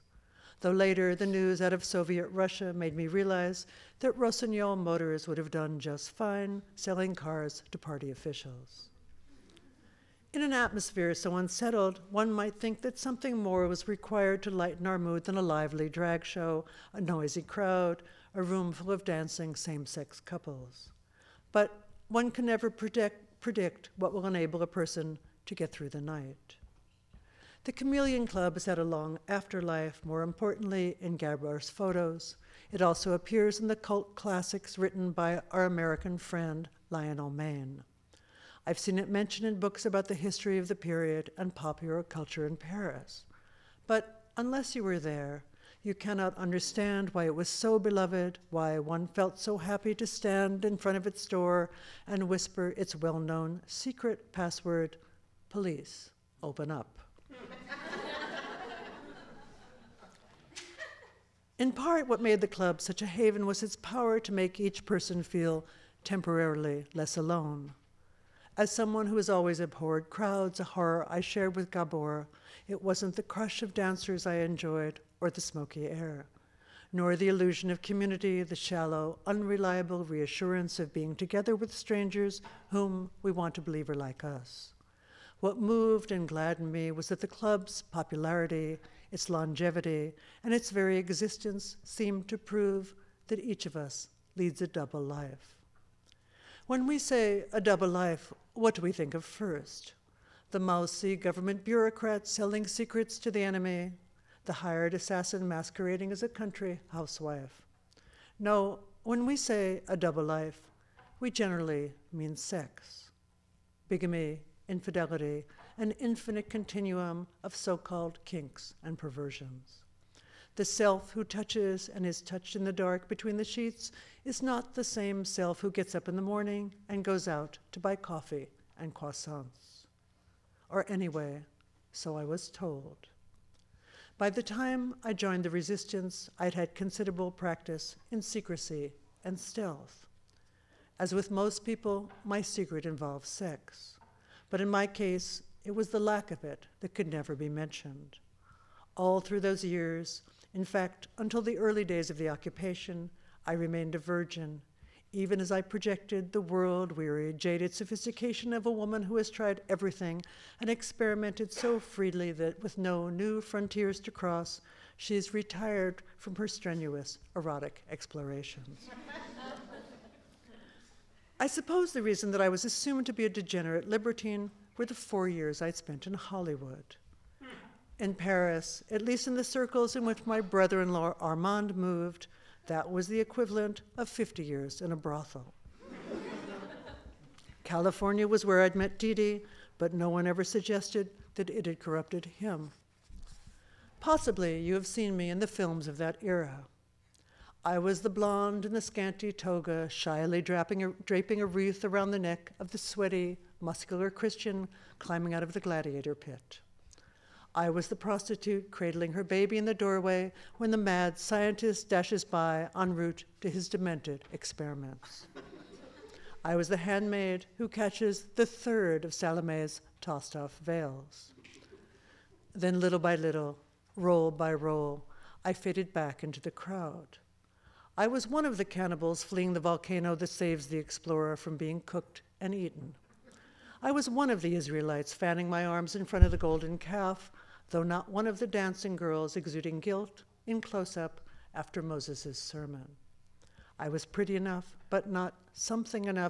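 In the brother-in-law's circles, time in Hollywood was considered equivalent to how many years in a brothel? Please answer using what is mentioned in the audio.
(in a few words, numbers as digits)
50.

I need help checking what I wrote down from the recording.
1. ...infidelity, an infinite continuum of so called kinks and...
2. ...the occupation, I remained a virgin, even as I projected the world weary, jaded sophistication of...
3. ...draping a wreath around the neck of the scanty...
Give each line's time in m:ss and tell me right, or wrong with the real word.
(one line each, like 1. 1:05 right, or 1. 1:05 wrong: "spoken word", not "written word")
1. 1:54 right
2. 2:32 right
3. 3:21 wrong: "sweaty", not "scanty".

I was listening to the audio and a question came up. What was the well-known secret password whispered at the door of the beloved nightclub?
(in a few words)
Police, open up.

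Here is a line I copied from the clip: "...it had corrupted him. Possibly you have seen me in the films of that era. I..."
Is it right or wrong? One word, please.
right.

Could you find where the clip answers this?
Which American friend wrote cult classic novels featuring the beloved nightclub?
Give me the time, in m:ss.
0:36.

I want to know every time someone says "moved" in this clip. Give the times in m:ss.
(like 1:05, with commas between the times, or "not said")
1:25, 3:01.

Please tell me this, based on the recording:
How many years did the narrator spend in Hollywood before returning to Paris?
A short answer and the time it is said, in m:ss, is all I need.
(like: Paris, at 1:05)
4, at 2:54.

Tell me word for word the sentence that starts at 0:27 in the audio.
The Chameleon Club has had a long afterlife, more importantly, in Gabriel's photos.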